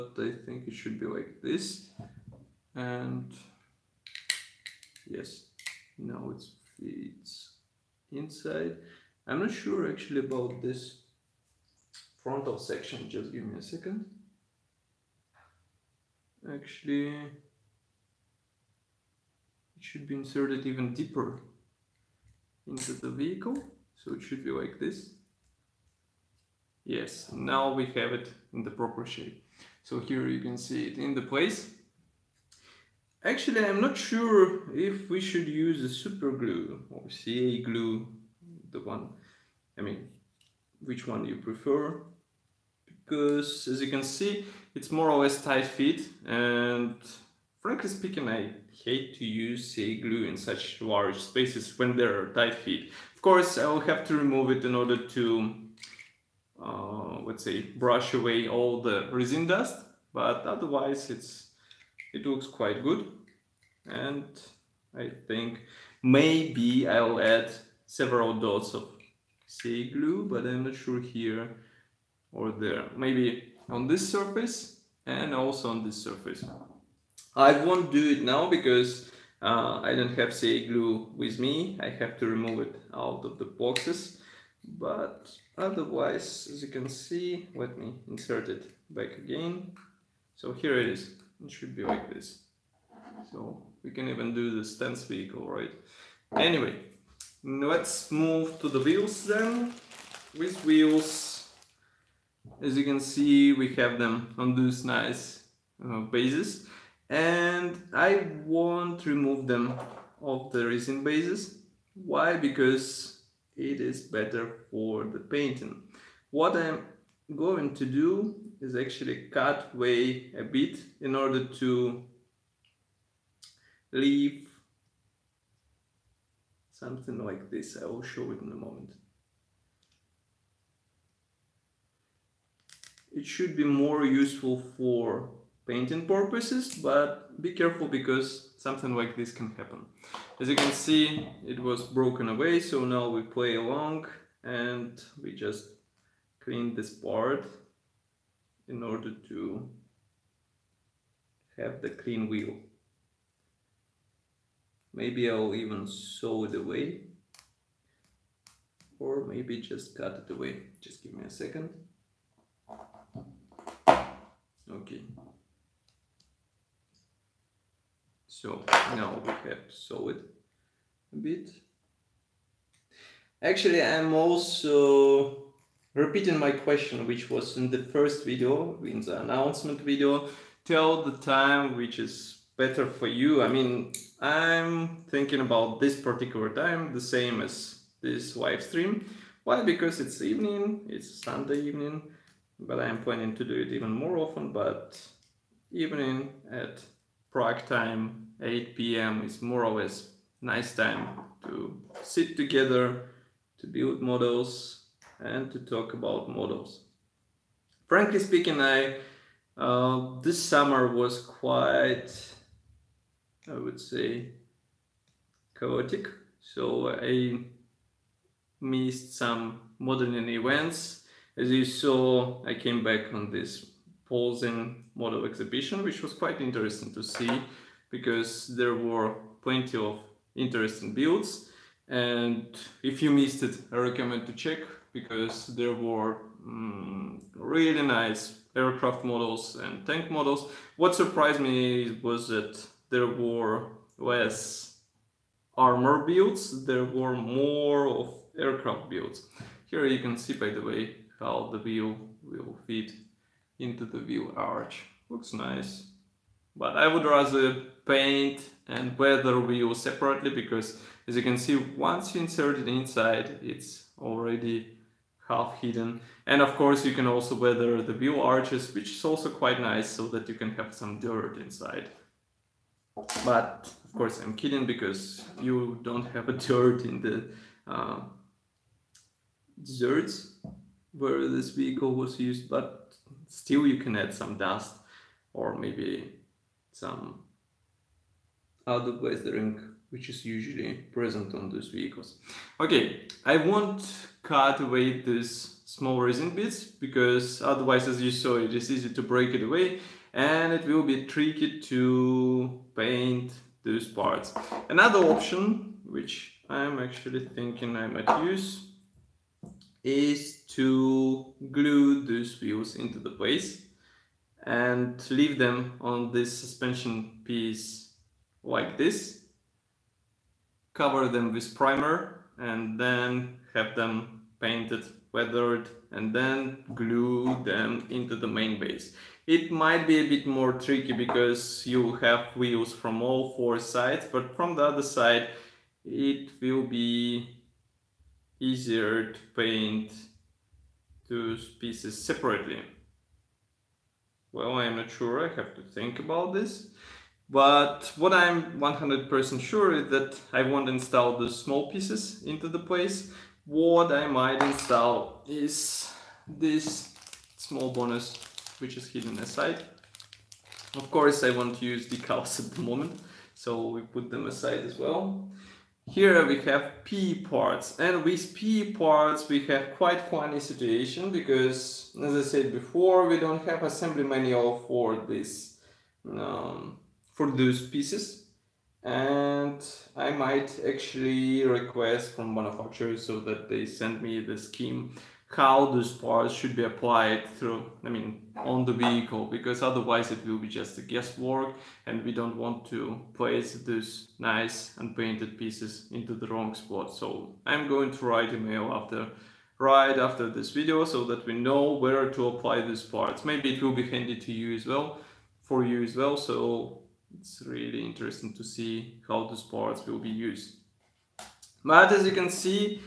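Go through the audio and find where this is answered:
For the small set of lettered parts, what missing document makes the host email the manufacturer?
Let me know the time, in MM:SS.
06:13.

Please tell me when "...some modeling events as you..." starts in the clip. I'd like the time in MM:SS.
03:39.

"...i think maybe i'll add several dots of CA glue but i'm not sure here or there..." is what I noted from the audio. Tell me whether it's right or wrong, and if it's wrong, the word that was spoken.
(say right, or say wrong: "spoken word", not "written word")
right.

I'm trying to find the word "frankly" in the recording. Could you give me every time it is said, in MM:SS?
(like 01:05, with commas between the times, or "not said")
00:47, 03:27.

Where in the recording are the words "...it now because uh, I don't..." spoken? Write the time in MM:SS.
01:18.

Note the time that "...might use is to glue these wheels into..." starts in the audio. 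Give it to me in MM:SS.
05:07.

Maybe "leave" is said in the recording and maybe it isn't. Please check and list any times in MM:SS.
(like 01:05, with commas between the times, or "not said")
02:03, 05:15.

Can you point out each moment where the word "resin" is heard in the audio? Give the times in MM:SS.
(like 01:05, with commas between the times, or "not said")
00:59, 01:50, 04:55.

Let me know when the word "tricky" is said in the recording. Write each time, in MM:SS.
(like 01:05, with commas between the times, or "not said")
05:01, 05:30.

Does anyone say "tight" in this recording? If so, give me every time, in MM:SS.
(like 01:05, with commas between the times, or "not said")
00:45, 00:52.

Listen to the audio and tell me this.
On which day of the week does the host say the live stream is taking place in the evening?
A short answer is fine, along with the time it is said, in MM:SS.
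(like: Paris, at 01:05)
Sunday, at 03:11.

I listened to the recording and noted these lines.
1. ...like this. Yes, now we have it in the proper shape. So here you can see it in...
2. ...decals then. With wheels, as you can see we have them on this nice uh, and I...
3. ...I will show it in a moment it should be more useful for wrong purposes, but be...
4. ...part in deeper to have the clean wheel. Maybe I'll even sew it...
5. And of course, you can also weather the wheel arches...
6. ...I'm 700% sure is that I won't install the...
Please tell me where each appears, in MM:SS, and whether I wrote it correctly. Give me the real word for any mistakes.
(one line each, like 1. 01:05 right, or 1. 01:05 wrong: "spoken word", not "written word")
1. 00:24 right
2. 01:38 wrong: "wheels", not "decals"
3. 02:07 wrong: "painting", not "wrong"
4. 02:26 wrong: "order", not "deeper"
5. 04:26 right
6. 05:48 wrong: "100", not "700".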